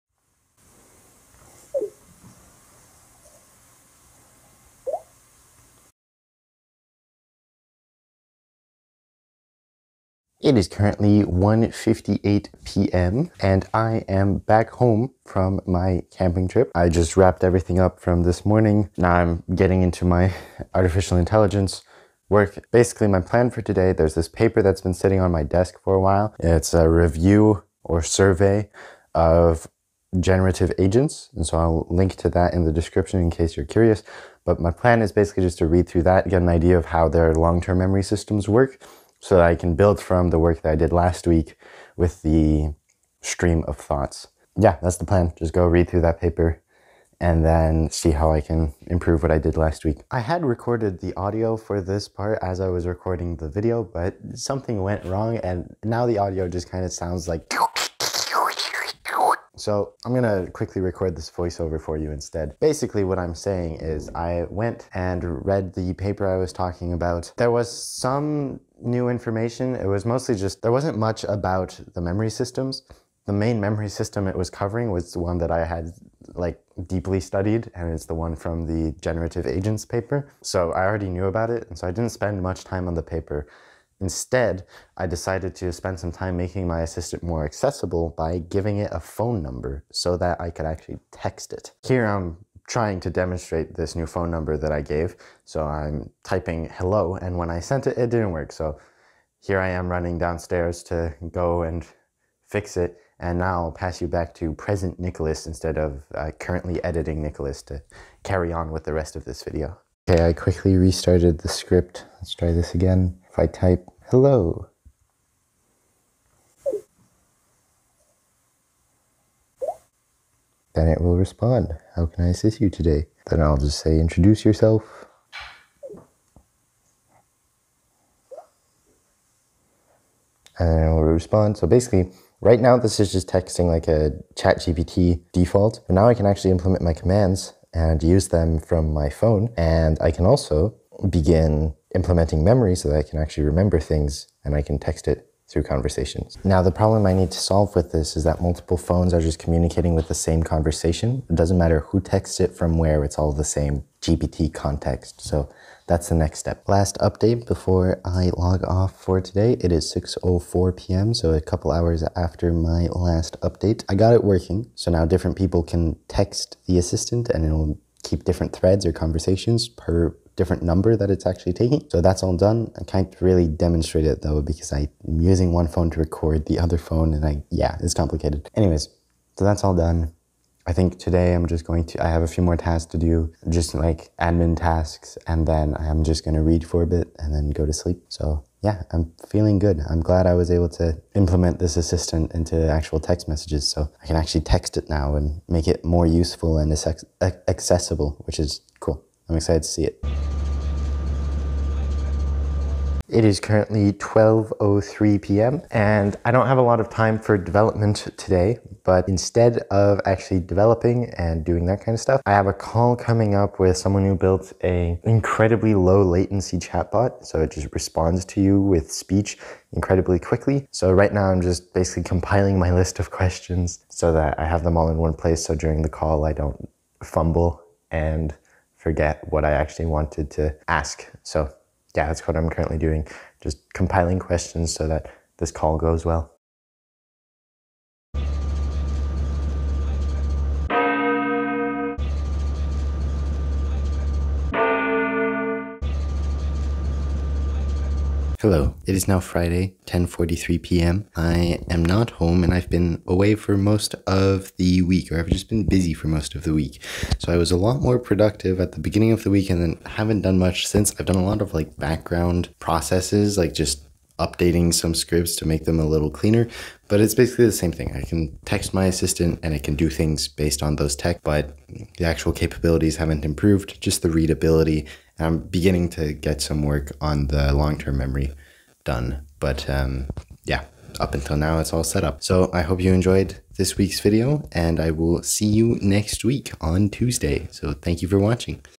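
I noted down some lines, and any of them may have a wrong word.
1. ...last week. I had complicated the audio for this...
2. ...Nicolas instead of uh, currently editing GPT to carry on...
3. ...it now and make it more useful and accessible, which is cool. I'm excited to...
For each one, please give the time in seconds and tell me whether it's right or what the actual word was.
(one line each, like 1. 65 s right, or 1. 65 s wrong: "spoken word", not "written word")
1. 49 s wrong: "recorded", not "complicated"
2. 104 s wrong: "Nicolas", not "GPT"
3. 194 s right.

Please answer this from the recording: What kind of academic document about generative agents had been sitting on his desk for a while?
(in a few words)
A review or survey.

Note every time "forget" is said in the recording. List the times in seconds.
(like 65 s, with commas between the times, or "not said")
228 s.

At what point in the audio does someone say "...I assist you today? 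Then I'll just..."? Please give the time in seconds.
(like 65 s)
122 s.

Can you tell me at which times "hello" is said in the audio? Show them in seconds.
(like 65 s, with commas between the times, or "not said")
96 s, 114 s, 248 s.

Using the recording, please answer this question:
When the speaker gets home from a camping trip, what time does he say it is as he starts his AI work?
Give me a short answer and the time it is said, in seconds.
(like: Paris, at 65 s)
1:58 p.m., at 11 s.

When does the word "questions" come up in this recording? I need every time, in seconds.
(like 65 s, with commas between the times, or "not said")
223 s, 234 s.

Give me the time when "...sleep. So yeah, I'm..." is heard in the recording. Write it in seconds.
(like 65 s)
187 s.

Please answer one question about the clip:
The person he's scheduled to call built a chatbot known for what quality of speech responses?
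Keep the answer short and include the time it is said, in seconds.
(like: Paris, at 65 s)
Incredibly low latency, at 215 s.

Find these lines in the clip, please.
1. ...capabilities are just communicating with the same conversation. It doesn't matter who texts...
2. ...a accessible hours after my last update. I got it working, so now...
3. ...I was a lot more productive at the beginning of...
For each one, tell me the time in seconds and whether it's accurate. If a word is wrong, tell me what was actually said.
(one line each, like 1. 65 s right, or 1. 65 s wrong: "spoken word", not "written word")
1. 148 s wrong: "phones", not "capabilities"
2. 161 s wrong: "couple", not "accessible"
3. 257 s right.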